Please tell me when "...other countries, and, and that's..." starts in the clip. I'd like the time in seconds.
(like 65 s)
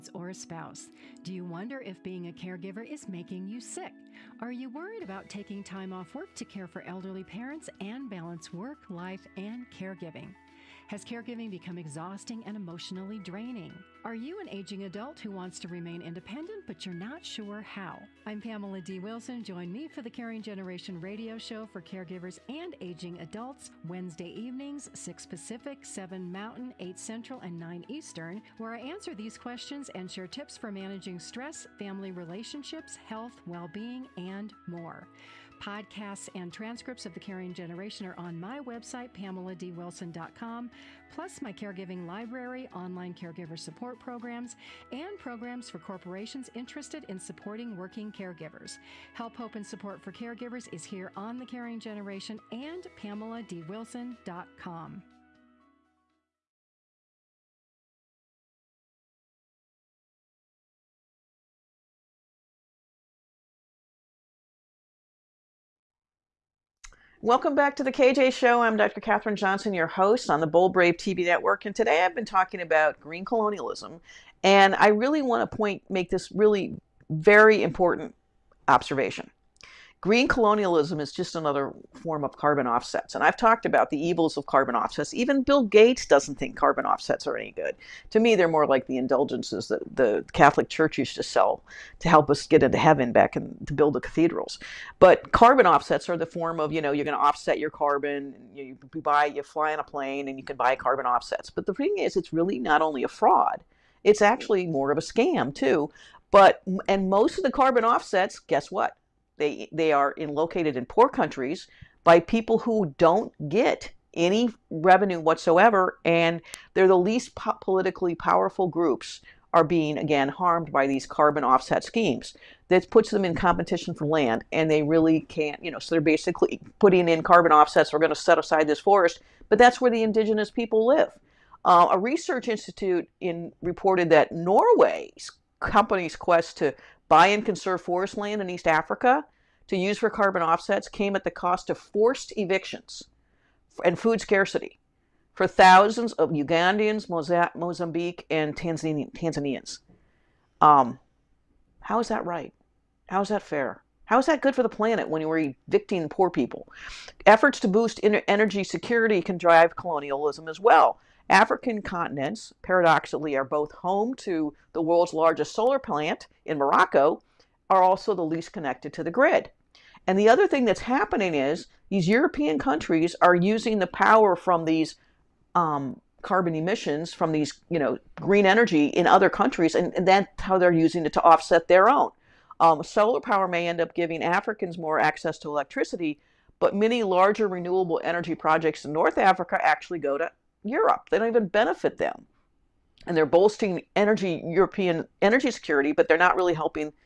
179 s.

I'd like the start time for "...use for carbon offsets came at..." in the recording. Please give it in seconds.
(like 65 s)
139 s.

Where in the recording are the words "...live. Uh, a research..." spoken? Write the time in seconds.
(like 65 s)
130 s.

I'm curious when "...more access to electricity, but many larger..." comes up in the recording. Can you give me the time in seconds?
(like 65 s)
184 s.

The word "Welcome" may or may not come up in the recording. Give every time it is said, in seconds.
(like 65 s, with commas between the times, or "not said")
67 s.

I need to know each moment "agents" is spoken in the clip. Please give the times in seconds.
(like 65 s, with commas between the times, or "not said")
not said.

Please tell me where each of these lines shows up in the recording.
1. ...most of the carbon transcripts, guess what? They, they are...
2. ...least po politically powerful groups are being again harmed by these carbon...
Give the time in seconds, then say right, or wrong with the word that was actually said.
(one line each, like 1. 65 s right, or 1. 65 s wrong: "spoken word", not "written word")
1. 107 s wrong: "offsets", not "transcripts"
2. 116 s right.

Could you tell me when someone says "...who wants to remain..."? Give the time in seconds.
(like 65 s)
15 s.